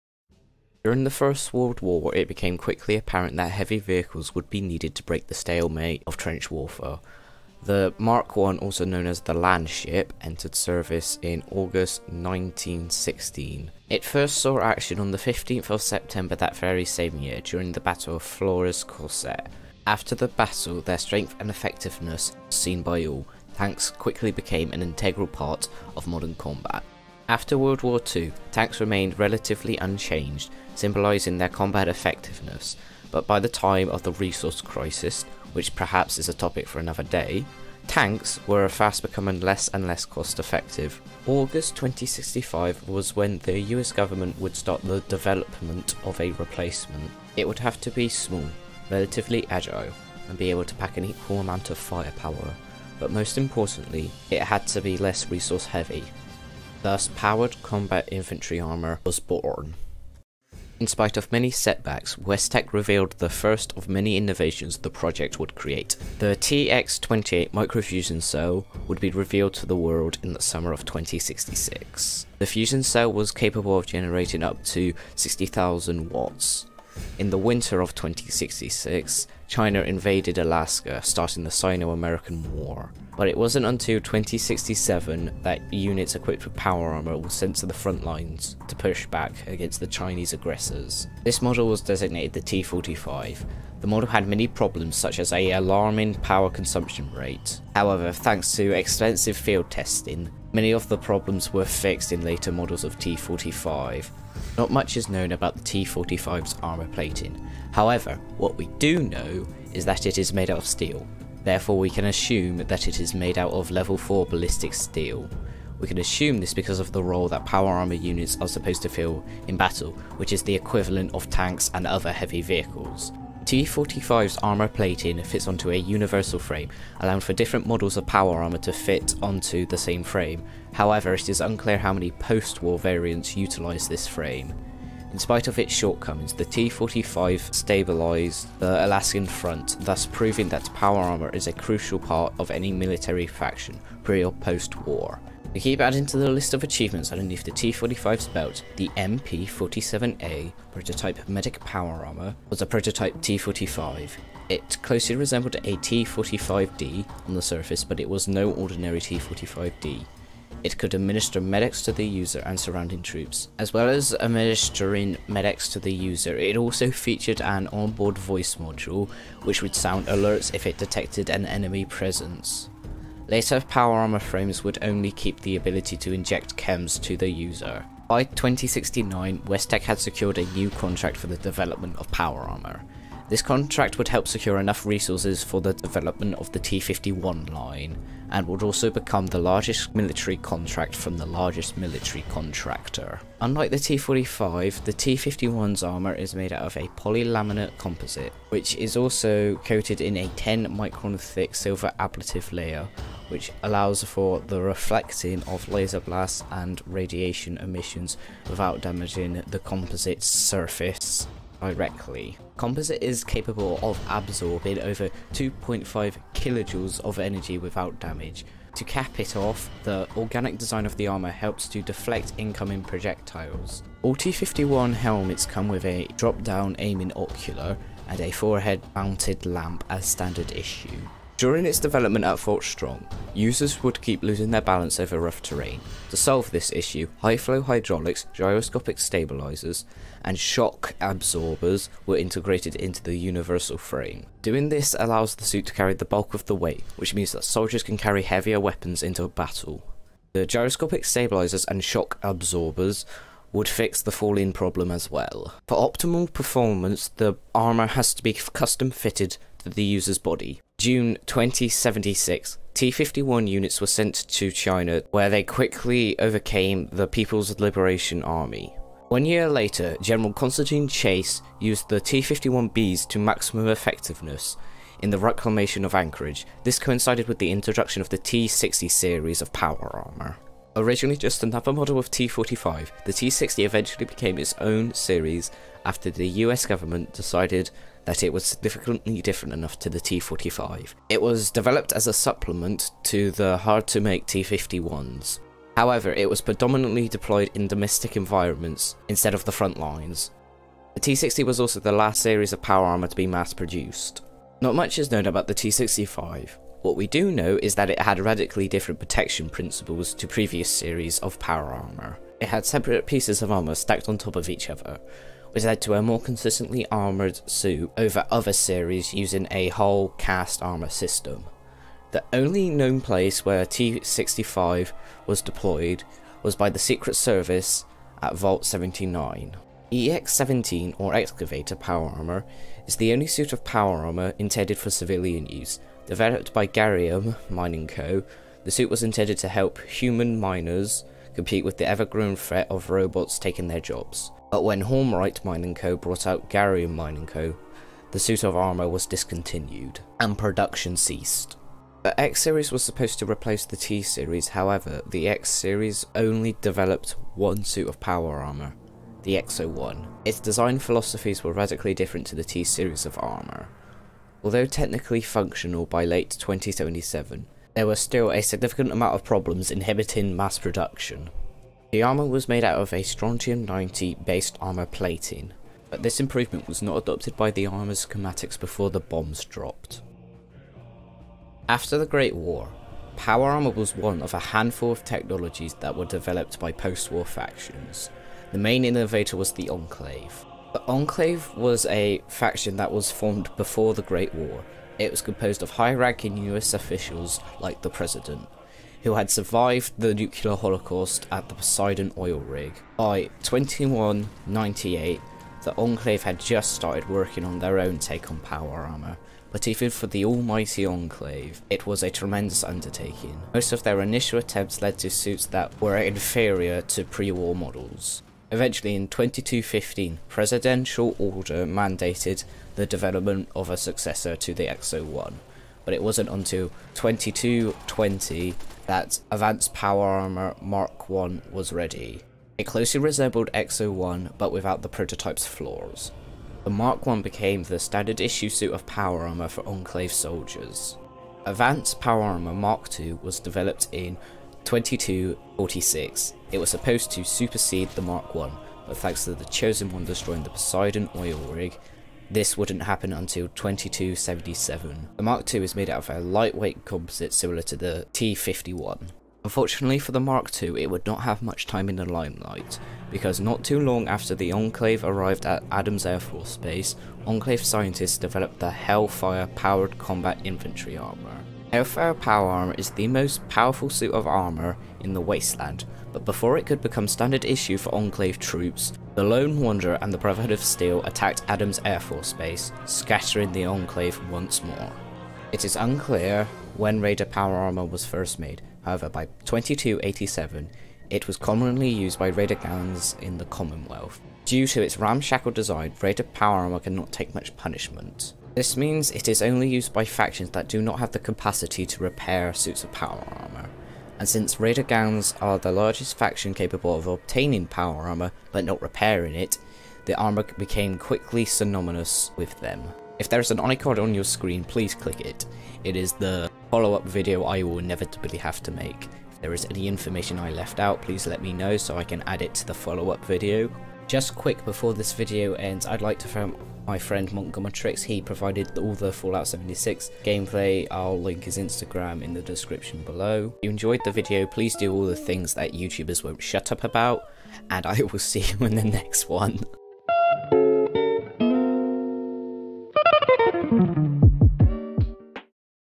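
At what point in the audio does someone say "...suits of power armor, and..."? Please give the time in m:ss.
8:22.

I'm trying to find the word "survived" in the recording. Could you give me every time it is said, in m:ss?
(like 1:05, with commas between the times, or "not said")
6:39.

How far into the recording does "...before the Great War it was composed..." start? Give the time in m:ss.
6:33.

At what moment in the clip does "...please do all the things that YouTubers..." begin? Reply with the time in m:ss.
8:54.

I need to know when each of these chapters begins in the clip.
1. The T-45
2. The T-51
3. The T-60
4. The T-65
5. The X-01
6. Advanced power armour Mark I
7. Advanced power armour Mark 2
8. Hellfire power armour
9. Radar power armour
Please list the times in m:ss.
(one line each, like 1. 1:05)
1. 1:00
2. 2:58
3. 4:29
4. 5:04
5. 5:51
6. 6:20
7. 7:21
8. 7:39
9. 8:05.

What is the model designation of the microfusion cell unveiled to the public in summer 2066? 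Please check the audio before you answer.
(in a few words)
TX-28.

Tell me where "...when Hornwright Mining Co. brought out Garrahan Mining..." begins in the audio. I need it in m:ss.
5:44.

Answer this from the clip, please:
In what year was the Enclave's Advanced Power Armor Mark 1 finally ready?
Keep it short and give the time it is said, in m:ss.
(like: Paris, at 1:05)
2220, at 7:06.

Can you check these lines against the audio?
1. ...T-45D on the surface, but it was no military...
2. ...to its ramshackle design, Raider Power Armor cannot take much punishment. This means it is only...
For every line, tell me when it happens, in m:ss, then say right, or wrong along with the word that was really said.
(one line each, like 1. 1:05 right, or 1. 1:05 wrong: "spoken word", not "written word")
1. 2:35 wrong: "ordinary", not "military"
2. 8:14 right.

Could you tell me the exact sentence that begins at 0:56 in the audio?
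Thus, powered combat infantry armor was born.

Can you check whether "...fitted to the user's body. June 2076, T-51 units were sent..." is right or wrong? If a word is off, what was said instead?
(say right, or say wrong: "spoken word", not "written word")
right.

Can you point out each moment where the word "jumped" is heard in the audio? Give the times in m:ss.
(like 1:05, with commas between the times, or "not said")
not said.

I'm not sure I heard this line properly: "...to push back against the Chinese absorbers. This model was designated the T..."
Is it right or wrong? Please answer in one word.
wrong.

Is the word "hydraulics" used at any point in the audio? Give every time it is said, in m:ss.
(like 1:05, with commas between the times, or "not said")
3:57.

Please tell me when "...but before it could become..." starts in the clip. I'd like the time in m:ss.
7:56.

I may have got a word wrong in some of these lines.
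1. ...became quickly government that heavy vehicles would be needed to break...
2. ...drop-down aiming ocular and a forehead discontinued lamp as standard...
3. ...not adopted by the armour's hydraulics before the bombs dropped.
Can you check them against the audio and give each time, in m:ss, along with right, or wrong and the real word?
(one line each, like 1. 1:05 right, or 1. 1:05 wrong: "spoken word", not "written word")
1. 0:02 wrong: "apparent", not "government"
2. 3:46 wrong: "mounted", not "discontinued"
3. 6:16 wrong: "schematics", not "hydraulics".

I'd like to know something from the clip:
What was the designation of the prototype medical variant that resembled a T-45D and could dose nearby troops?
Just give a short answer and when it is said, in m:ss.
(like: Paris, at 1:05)
MP-47A, at 2:28.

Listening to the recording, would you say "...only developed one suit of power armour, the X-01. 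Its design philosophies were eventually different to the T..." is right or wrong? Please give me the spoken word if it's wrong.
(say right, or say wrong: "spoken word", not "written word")
wrong: "radically", not "eventually".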